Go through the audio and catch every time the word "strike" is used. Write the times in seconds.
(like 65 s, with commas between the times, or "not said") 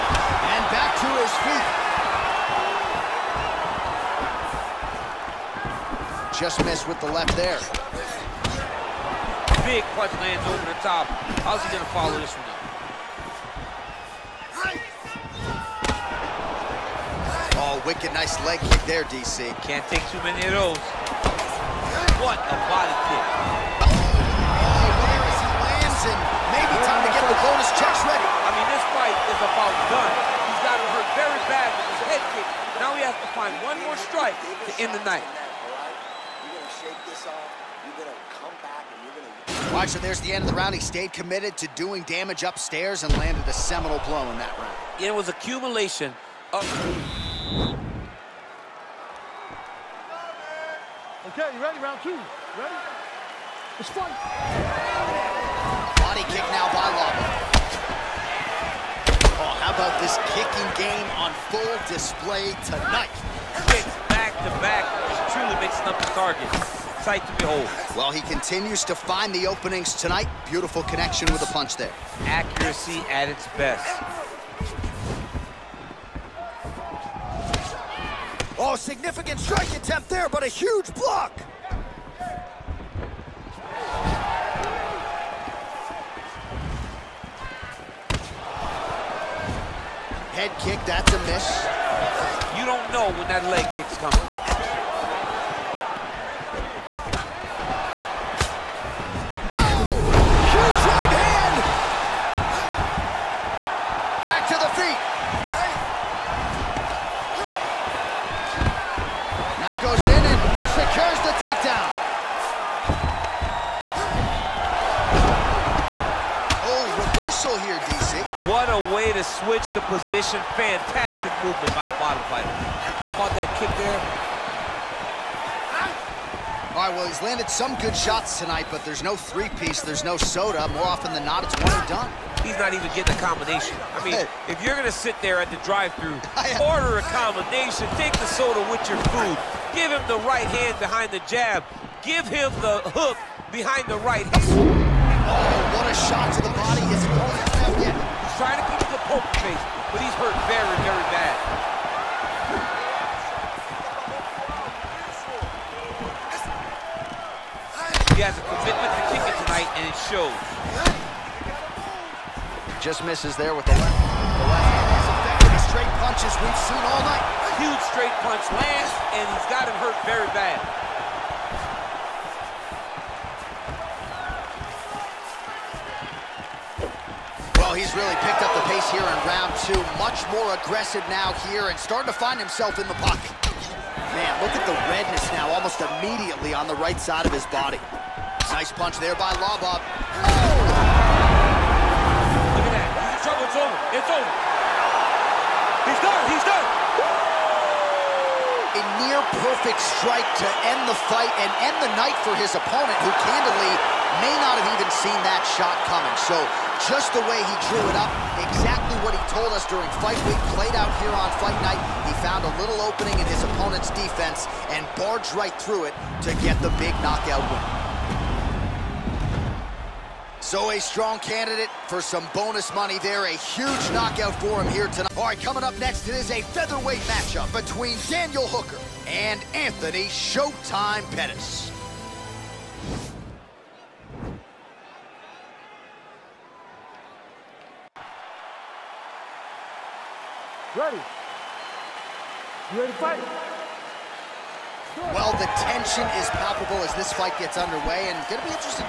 34 s, 79 s, 199 s.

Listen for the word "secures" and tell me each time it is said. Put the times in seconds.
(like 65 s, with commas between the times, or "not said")
110 s.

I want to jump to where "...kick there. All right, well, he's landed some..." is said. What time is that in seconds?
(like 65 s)
123 s.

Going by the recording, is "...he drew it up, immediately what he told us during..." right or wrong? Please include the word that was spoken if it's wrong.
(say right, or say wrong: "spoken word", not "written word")
wrong: "exactly", not "immediately".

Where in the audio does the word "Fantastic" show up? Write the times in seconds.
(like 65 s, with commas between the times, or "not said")
120 s.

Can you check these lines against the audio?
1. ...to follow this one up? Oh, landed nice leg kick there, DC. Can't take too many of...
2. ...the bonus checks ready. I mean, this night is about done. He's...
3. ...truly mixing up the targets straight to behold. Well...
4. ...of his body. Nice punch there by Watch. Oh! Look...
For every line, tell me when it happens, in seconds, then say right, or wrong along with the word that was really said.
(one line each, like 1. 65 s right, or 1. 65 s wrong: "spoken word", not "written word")
1. 11 s wrong: "wicked", not "landed"
2. 27 s wrong: "fight", not "night"
3. 65 s wrong: "sight", not "straight"
4. 187 s wrong: "Lobov", not "Watch".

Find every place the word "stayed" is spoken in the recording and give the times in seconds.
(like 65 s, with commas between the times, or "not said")
40 s.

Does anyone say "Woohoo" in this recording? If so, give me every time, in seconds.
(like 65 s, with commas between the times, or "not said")
not said.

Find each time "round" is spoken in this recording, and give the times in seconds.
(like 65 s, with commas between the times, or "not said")
40 s, 44 s, 51 s, 179 s.